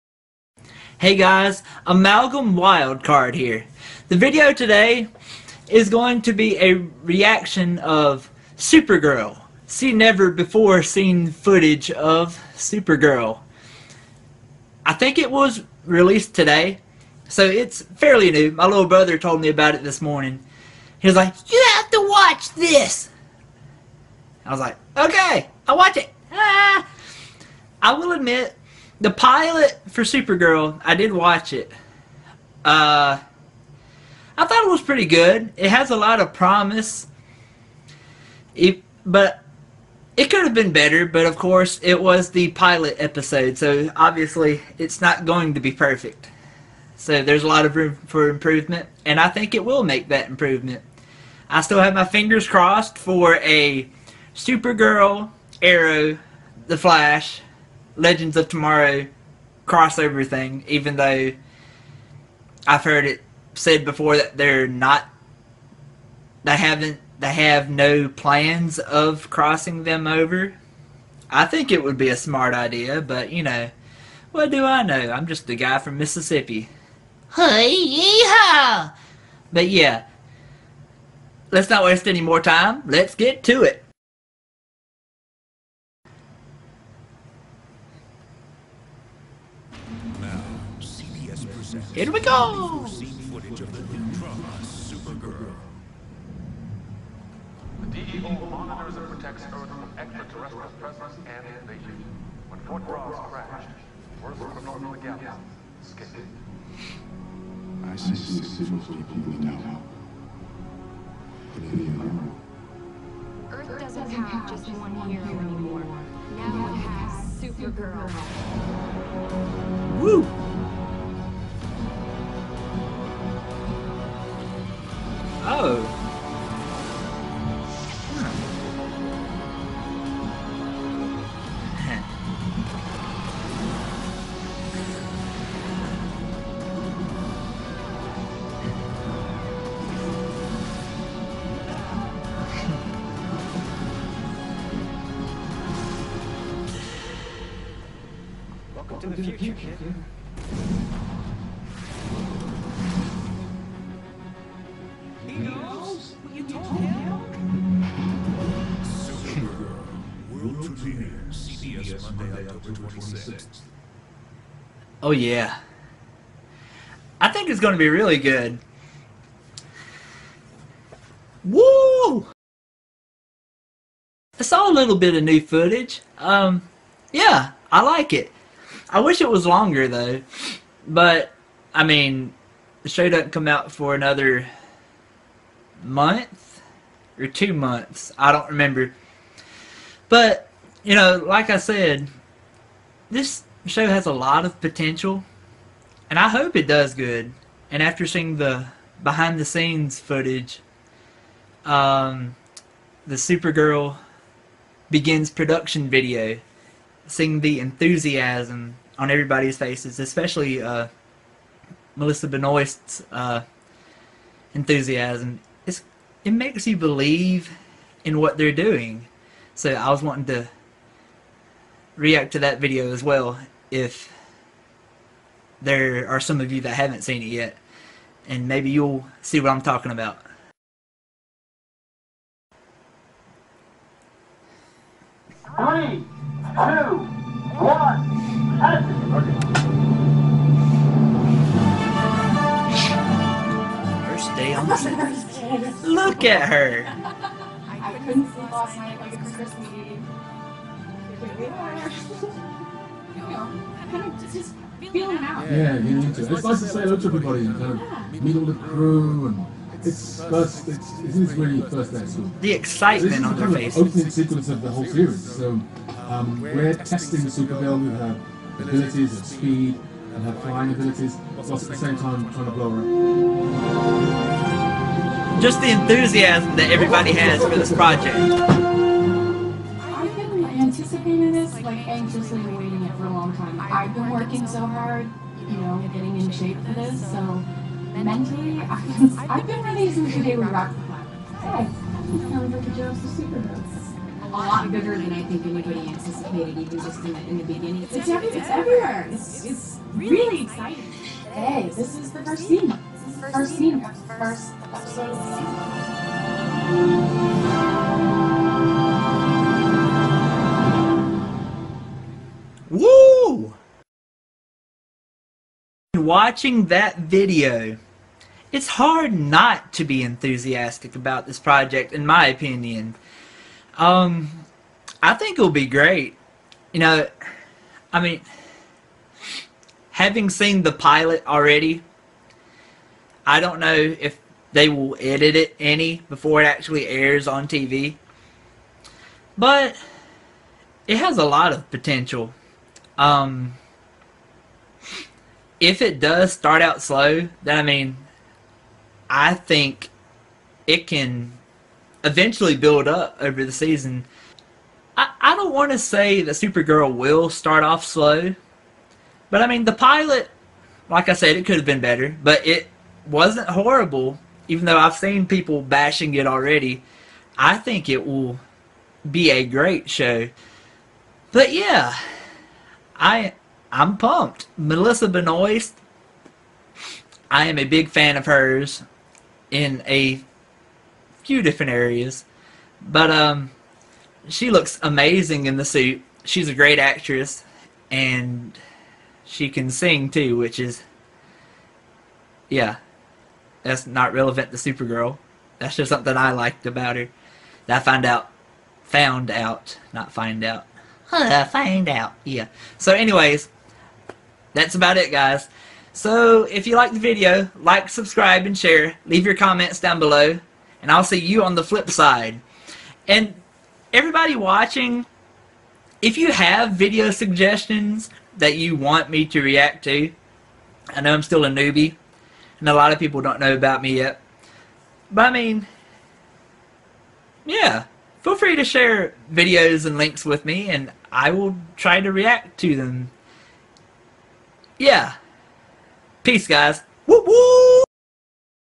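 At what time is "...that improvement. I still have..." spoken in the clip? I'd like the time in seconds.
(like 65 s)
50 s.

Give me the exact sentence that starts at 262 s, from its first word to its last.
The excitement so on their face.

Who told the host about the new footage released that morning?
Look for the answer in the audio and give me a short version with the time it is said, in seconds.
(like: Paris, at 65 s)
Little brother, at 18 s.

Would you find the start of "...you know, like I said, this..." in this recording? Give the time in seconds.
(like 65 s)
190 s.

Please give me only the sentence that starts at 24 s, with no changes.
I was like, okay, I'll watch it.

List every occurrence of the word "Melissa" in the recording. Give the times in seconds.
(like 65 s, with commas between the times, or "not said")
211 s, 374 s.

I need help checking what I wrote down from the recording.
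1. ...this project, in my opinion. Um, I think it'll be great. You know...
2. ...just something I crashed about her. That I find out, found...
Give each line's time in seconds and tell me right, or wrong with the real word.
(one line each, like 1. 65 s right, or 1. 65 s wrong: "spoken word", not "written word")
1. 321 s right
2. 395 s wrong: "liked", not "crashed".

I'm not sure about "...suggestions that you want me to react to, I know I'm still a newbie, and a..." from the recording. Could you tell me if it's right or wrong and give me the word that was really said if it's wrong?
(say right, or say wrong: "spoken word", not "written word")
right.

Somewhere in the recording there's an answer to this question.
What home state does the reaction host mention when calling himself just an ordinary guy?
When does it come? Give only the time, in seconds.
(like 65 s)
75 s.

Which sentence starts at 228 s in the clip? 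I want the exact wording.
And maybe you'll see what I'm talking about.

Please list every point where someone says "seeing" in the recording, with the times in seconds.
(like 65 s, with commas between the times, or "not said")
198 s, 207 s.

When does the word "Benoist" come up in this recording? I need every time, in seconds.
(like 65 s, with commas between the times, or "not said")
212 s, 375 s.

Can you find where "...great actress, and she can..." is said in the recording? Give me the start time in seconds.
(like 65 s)
386 s.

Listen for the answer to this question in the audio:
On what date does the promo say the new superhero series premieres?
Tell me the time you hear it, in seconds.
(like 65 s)
162 s.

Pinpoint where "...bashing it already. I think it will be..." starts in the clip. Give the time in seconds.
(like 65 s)
365 s.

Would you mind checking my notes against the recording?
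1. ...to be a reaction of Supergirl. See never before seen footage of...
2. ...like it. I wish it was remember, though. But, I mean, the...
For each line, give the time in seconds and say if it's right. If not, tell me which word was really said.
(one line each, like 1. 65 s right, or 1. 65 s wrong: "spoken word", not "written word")
1. 6 s right
2. 177 s wrong: "longer", not "remember".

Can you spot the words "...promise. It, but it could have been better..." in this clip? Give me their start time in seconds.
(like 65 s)
36 s.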